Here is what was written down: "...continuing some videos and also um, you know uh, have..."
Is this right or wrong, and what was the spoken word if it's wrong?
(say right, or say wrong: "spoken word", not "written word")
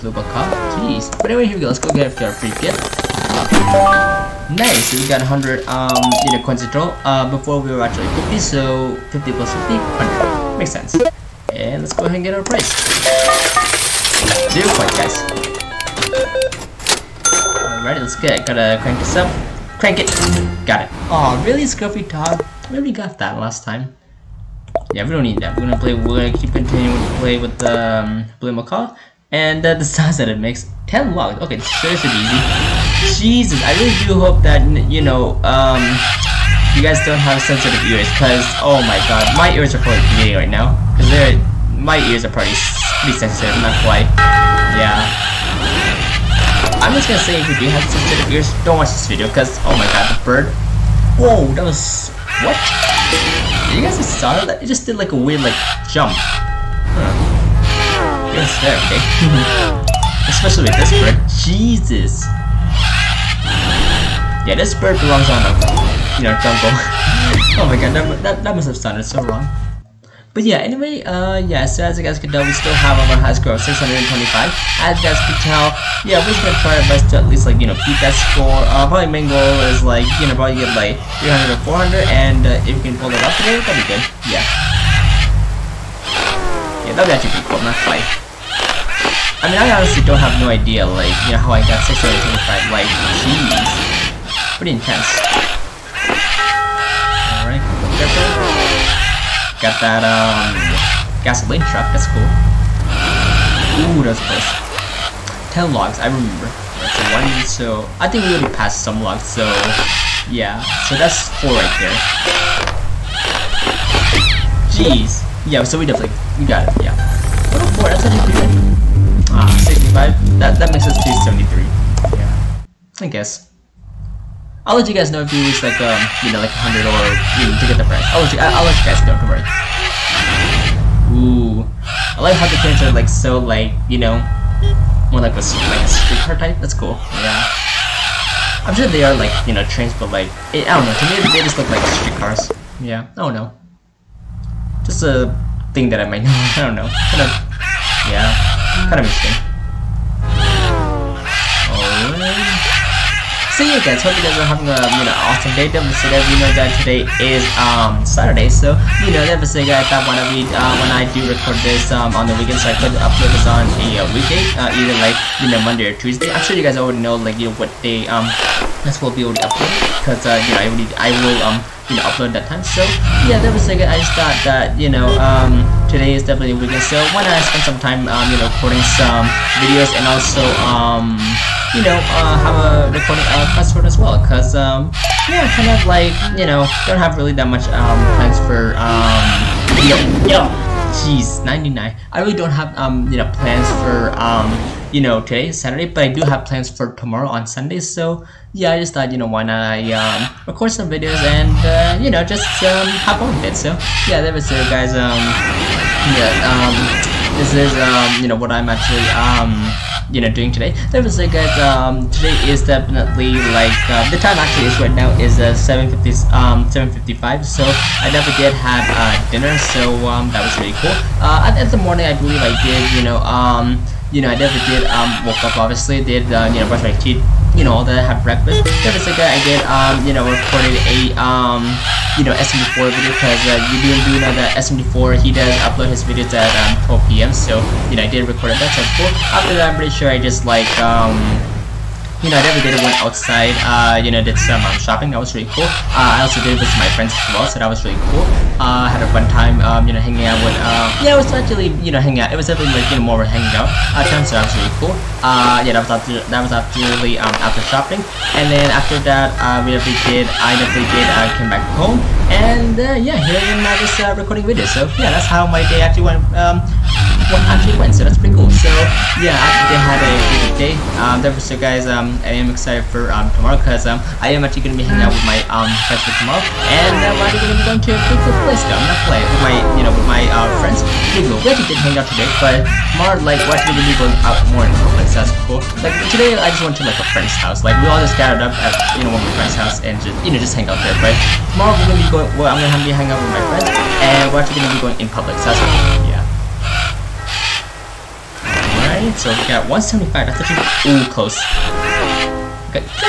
wrong: "recording", not "continuing".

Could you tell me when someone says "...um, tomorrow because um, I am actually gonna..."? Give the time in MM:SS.
04:33.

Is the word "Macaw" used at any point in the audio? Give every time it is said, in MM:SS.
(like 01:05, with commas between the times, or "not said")
00:00, 00:28.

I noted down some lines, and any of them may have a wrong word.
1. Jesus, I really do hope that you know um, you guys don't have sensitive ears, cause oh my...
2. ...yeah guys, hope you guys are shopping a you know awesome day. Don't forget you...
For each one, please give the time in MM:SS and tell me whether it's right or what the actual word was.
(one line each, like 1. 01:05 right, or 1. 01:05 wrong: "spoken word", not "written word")
1. 00:33 right
2. 02:33 wrong: "having", not "shopping".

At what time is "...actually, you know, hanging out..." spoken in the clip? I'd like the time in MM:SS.
04:11.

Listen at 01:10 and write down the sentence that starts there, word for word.
But yeah, anyway, uh, yeah, so as you guys can tell, we still have our high score of 625.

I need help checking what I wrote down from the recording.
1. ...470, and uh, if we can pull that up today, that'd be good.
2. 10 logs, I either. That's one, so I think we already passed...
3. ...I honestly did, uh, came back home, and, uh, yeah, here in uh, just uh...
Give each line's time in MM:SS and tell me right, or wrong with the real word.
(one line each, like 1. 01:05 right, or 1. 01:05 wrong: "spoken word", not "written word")
1. 01:21 wrong: "400", not "470"
2. 01:45 wrong: "remember", not "either"
3. 04:20 wrong: "definitely", not "honestly".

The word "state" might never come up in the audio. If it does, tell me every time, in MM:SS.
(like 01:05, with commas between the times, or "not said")
not said.